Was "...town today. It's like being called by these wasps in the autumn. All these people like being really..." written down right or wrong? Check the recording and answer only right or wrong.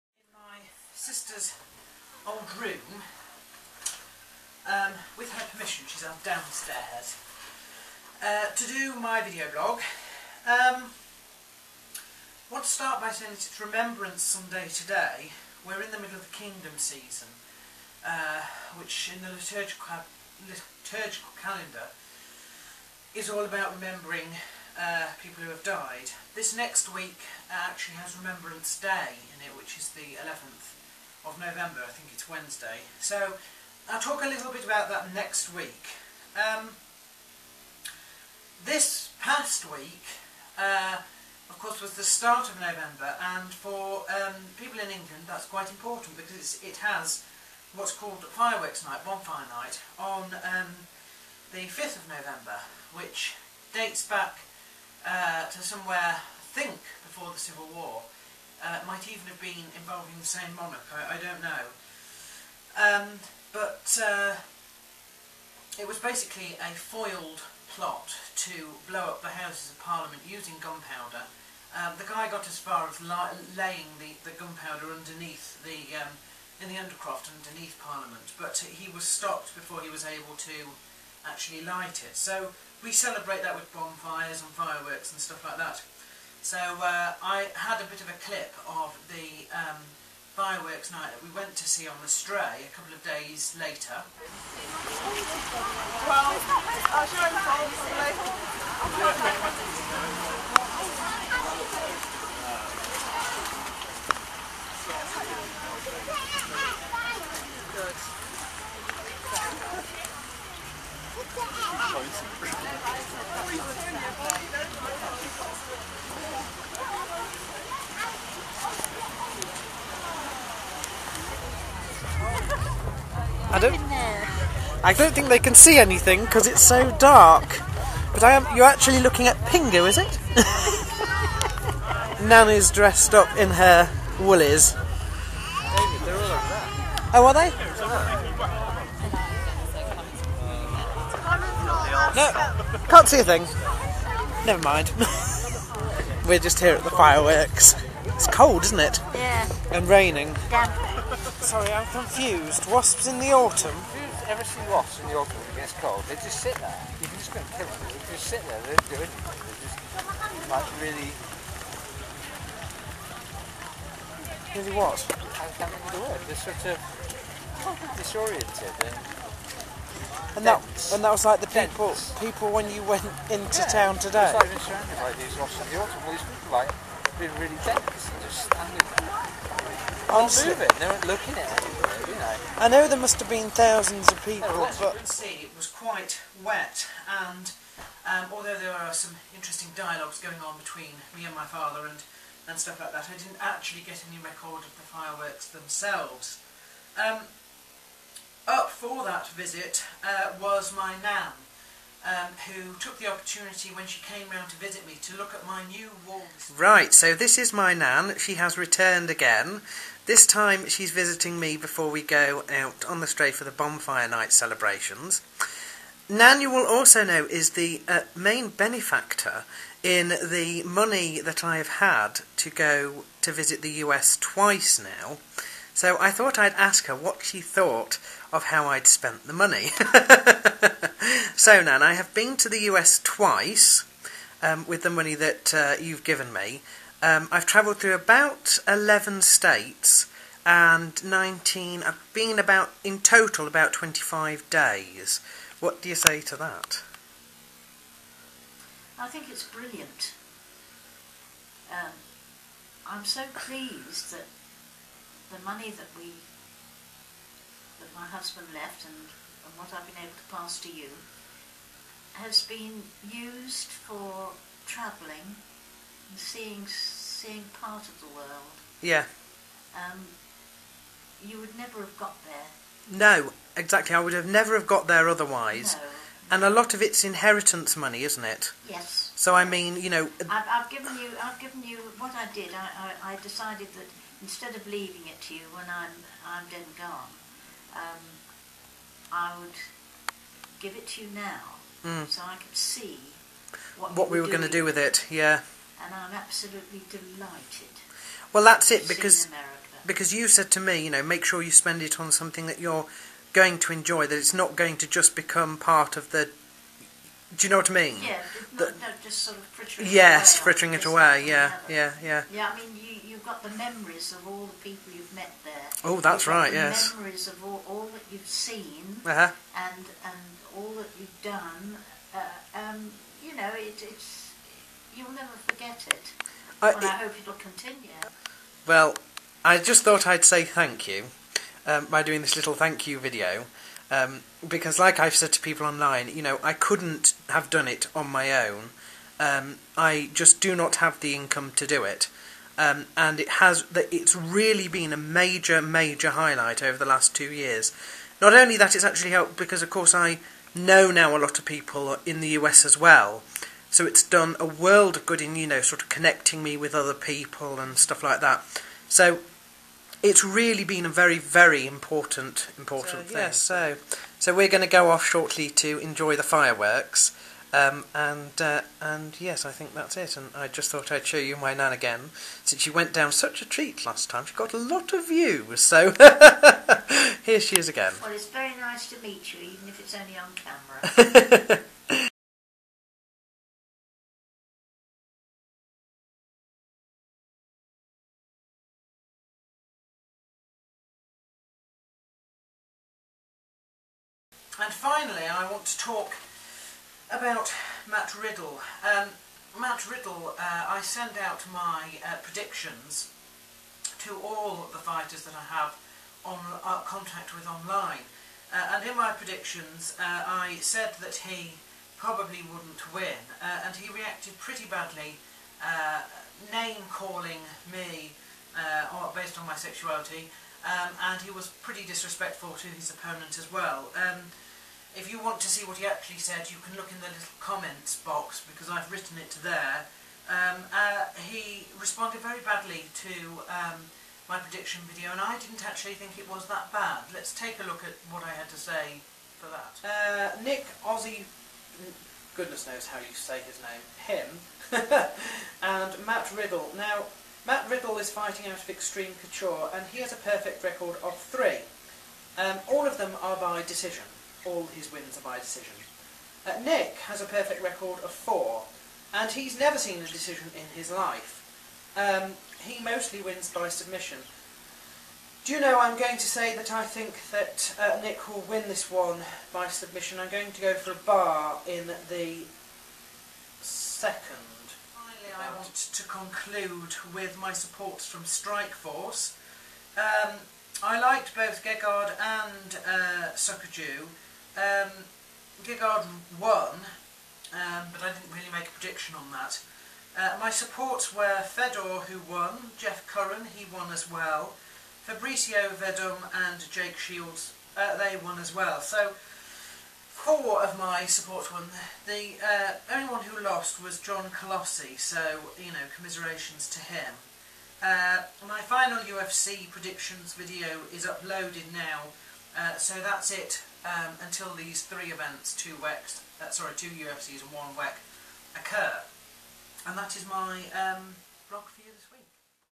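wrong.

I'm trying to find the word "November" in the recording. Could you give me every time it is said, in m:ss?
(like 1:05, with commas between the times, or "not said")
0:31, 0:42, 0:52.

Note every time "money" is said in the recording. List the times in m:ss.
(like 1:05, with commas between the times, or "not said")
3:40, 3:49, 3:54, 4:15, 4:37.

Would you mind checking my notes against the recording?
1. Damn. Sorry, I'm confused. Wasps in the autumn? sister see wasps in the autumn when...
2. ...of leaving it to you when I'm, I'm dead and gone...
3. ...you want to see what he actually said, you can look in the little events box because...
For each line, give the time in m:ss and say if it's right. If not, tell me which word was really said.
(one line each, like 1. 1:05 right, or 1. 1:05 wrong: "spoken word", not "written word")
1. 2:30 wrong: "never", not "sister"
2. 4:44 right
3. 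7:05 wrong: "comments", not "events".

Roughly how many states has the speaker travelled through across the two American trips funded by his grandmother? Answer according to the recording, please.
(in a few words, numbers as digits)
11.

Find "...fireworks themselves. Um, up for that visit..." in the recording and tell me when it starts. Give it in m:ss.
3:14.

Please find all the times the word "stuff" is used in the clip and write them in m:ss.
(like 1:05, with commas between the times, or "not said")
1:25, 3:12, 5:57.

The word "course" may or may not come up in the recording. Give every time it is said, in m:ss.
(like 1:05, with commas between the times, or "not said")
0:41, 5:49.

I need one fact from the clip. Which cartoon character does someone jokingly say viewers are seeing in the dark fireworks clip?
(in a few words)
Pingu.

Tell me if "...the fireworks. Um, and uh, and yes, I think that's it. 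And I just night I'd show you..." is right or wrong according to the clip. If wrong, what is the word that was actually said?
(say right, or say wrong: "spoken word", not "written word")
wrong: "thought", not "night".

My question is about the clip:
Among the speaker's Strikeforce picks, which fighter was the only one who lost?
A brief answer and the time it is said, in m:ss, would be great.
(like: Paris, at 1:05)
John Colossi, at 8:23.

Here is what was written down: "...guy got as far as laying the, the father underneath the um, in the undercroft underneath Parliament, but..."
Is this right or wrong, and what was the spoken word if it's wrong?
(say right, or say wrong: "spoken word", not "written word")
wrong: "gunpowder", not "father".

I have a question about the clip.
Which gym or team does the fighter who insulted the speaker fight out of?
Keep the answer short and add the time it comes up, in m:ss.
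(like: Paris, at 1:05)
Extreme Couture, at 7:28.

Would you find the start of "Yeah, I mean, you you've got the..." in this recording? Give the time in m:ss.
5:12.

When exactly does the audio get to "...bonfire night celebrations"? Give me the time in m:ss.
3:33.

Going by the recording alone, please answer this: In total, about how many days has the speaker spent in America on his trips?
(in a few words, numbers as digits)
25 days.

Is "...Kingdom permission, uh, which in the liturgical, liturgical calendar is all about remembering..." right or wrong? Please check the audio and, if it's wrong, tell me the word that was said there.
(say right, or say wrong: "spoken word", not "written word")
wrong: "season", not "permission".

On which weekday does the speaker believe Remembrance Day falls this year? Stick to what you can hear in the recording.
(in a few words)
Wednesday.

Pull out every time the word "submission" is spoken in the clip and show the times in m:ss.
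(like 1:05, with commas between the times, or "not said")
7:43, 7:49.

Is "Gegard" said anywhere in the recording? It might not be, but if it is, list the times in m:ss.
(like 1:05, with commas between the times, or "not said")
8:01, 8:05.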